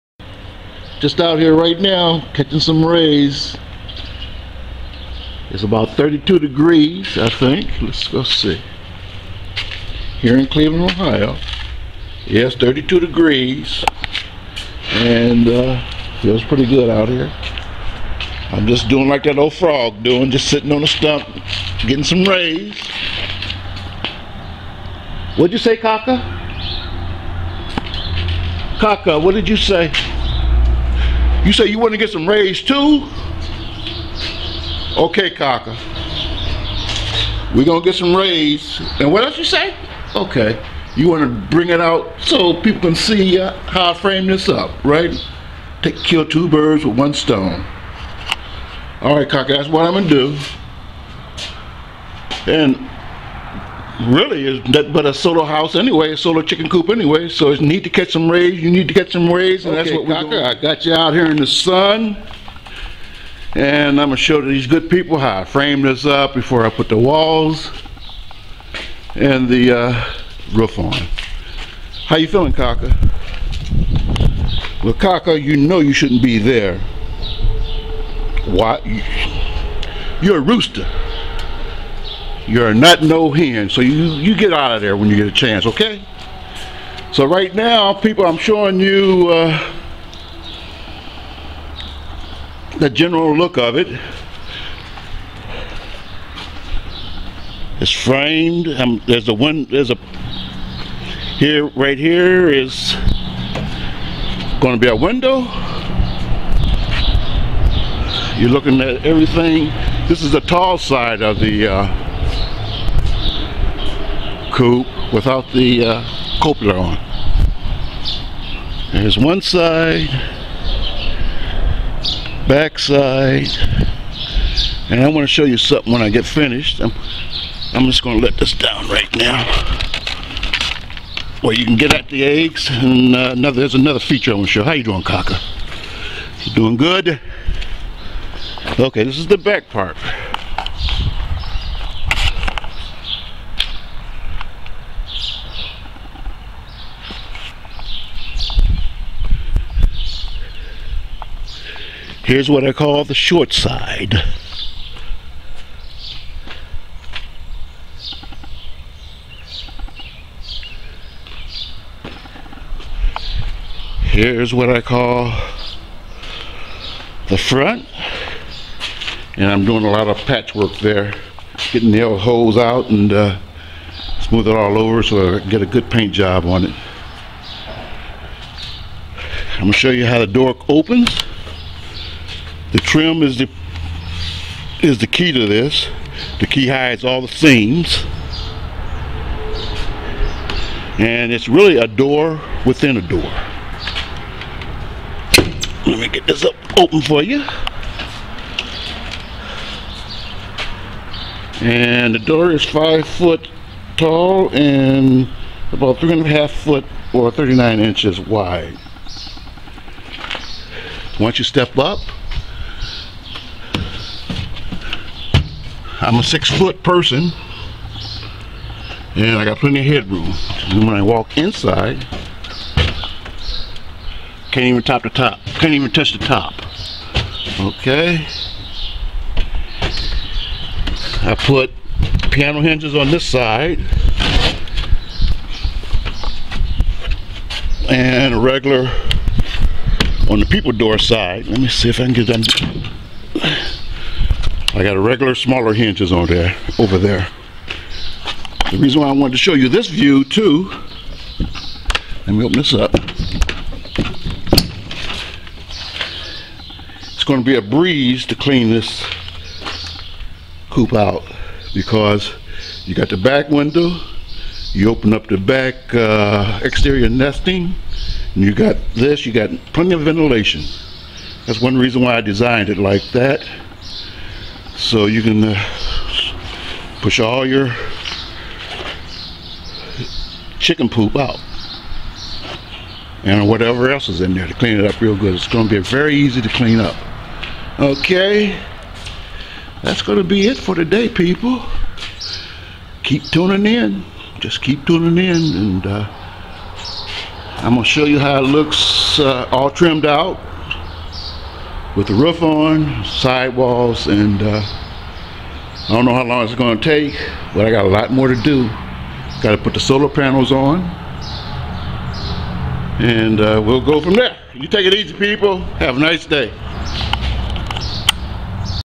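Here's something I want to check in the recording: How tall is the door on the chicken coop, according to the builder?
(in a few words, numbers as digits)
5 feet.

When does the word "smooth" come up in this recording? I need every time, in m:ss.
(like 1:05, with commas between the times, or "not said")
2:54.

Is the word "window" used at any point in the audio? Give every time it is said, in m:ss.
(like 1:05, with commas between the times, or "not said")
1:44, 4:23.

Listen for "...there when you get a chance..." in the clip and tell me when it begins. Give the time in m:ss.
1:24.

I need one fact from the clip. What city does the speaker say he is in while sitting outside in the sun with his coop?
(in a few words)
Cleveland, Ohio.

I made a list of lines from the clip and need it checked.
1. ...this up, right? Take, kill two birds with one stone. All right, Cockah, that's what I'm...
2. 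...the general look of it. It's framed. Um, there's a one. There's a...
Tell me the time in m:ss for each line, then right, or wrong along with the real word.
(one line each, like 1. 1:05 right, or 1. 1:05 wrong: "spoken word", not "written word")
1. 0:44 right
2. 1:32 right.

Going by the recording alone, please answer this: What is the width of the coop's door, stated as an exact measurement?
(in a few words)
39 inches.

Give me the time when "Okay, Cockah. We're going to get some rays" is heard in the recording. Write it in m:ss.
0:34.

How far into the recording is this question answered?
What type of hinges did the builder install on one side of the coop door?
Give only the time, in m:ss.
3:52.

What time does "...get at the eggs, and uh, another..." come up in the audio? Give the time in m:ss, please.
2:11.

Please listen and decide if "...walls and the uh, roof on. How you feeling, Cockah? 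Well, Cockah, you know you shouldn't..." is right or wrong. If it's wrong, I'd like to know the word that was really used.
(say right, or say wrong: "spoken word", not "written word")
right.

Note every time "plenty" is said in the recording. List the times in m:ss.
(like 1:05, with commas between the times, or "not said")
3:39, 4:29.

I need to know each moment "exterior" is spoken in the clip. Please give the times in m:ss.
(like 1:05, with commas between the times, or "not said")
4:26.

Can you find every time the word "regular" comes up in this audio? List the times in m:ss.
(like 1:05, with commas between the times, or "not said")
3:58, 4:05.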